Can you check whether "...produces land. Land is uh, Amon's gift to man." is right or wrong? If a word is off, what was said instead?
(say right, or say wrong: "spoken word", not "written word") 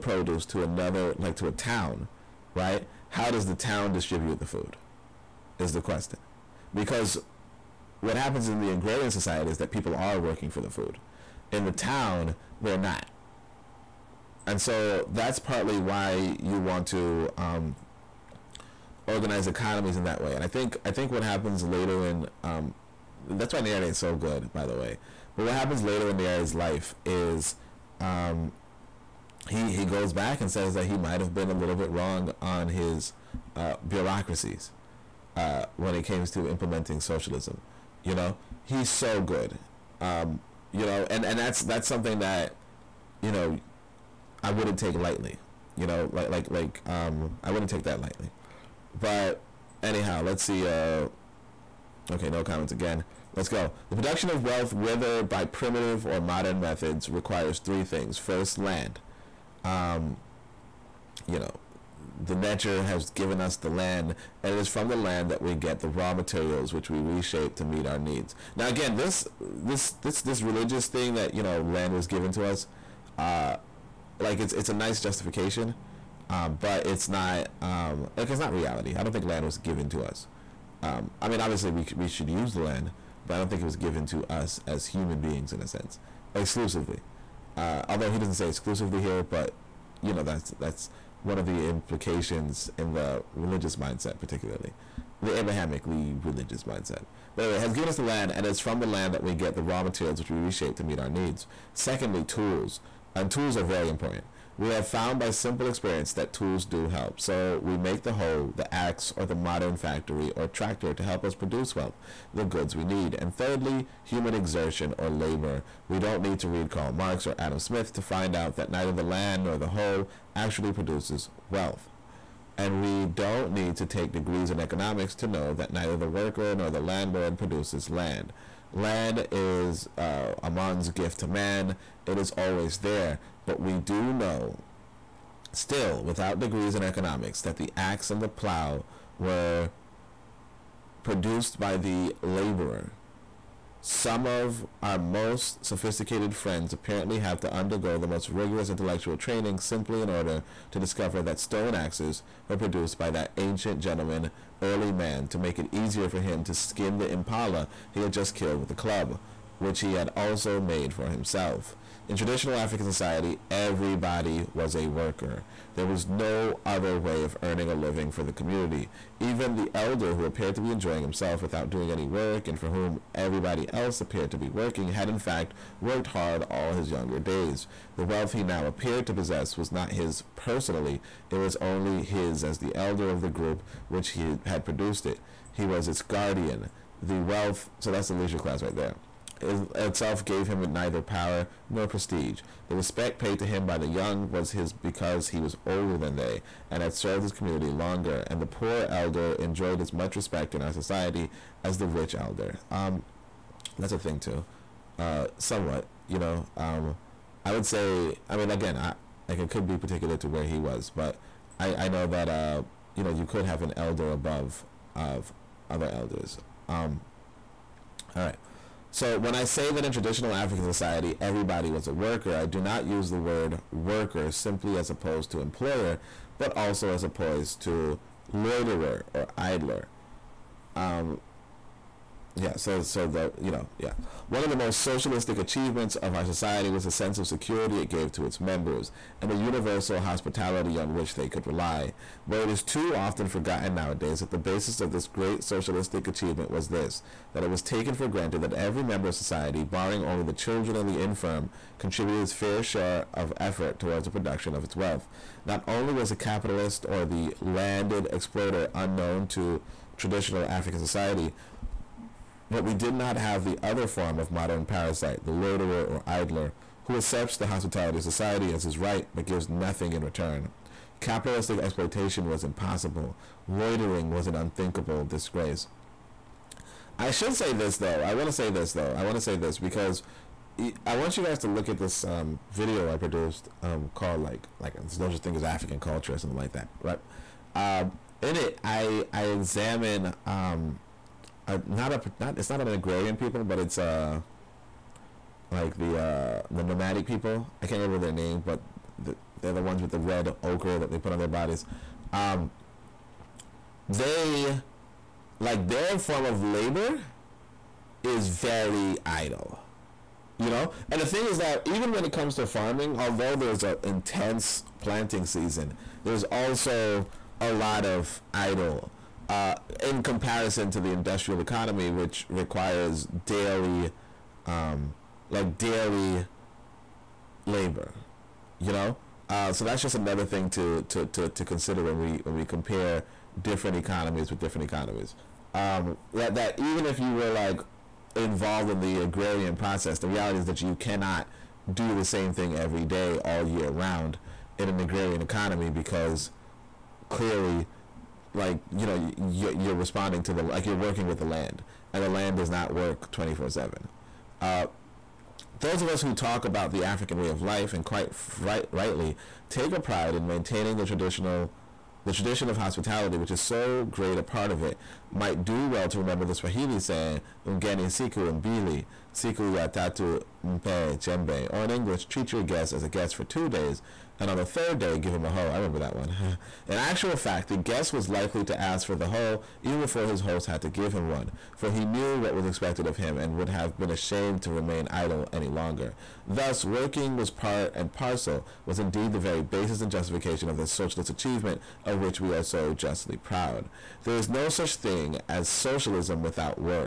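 right.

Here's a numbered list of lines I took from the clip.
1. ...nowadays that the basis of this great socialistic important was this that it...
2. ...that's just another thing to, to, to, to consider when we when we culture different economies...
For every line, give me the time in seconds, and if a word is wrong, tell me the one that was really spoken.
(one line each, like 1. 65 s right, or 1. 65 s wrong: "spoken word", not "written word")
1. 243 s wrong: "achievement", not "important"
2. 329 s wrong: "compare", not "culture".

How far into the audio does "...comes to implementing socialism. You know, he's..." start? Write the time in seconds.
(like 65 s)
36 s.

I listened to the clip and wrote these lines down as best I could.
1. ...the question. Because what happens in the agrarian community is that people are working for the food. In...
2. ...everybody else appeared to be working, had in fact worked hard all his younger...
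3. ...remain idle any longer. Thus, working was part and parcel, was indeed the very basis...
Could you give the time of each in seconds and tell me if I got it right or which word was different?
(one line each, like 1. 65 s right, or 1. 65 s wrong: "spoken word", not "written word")
1. 5 s wrong: "society", not "community"
2. 173 s right
3. 384 s right.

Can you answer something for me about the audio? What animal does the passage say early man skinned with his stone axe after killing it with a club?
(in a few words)
Impala.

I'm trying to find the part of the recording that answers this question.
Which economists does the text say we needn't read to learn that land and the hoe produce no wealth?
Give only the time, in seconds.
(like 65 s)
116 s.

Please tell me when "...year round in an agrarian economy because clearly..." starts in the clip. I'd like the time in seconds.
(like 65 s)
343 s.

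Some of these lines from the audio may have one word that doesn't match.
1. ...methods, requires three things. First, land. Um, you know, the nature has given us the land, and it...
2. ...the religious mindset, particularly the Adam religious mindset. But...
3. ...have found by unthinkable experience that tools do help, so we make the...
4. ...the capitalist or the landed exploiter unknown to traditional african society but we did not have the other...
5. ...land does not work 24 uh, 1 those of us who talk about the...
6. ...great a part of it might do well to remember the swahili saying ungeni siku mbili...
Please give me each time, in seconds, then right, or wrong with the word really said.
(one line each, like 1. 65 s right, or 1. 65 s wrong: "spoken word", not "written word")
1. 56 s right
2. 92 s wrong: "Abrahamically", not "Adam"
3. 104 s wrong: "simple", not "unthinkable"
4. 256 s right
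5. 352 s wrong: "7", not "1"
6. 363 s right.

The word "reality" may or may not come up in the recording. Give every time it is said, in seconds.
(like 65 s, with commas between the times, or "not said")
78 s, 340 s.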